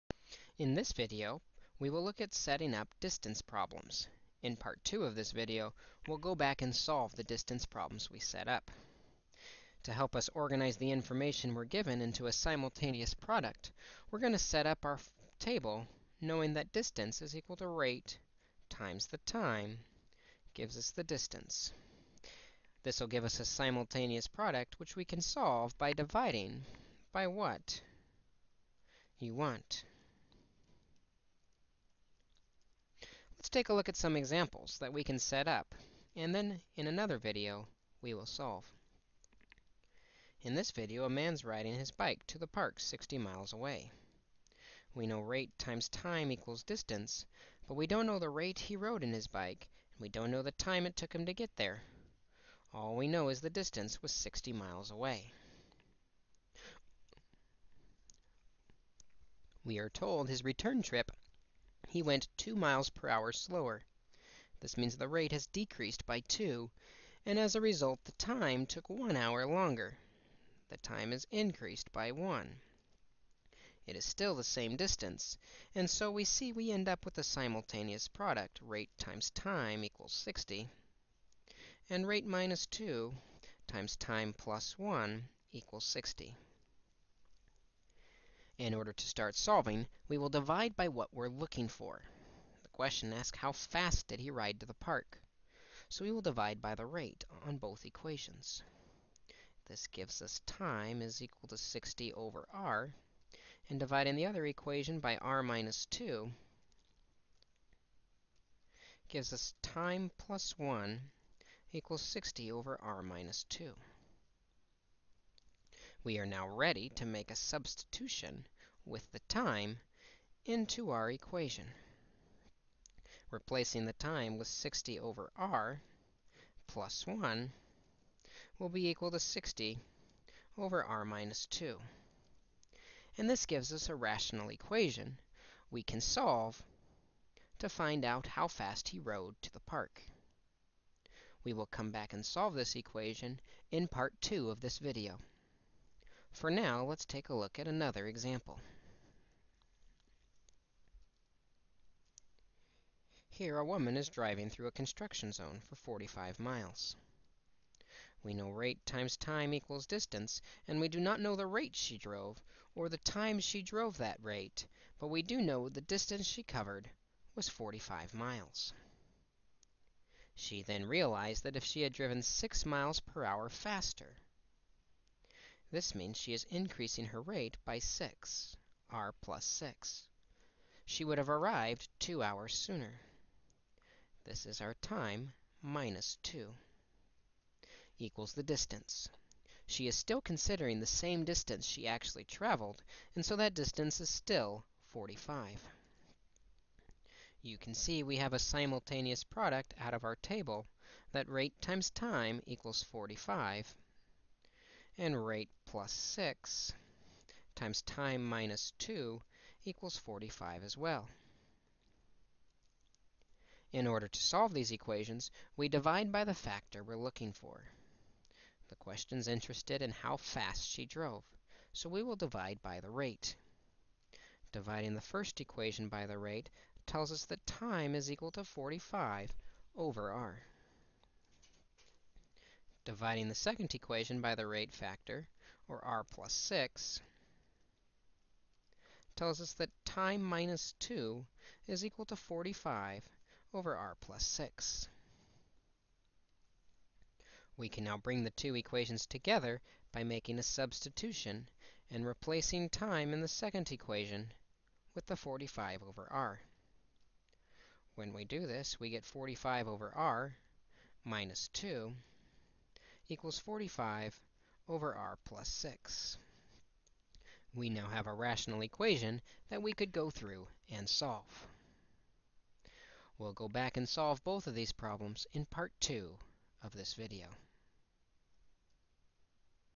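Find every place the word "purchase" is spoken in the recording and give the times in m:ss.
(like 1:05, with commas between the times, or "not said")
not said.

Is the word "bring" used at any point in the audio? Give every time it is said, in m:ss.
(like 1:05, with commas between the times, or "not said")
4:07.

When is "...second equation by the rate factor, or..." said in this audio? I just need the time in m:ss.
3:53.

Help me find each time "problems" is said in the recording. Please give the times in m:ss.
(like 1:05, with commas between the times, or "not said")
0:03, 0:07, 4:34.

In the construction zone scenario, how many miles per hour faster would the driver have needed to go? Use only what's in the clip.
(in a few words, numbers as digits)
6.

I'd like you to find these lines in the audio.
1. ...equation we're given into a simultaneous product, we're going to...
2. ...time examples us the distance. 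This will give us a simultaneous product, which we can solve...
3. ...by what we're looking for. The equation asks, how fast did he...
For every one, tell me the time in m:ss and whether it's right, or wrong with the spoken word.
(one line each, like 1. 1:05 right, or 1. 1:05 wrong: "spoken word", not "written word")
1. 0:10 wrong: "information", not "equation"
2. 0:19 wrong: "gives", not "examples"
3. 1:30 wrong: "question", not "equation".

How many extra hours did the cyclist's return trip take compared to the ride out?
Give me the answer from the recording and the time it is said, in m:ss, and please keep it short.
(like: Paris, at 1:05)
1 hour, at 1:08.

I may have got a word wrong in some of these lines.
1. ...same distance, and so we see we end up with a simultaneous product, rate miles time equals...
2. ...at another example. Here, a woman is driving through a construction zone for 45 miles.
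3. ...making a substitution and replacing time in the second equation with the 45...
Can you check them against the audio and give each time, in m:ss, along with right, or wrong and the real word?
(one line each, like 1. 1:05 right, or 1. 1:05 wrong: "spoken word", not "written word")
1. 1:14 wrong: "times", not "miles"
2. 2:27 right
3. 4:10 right.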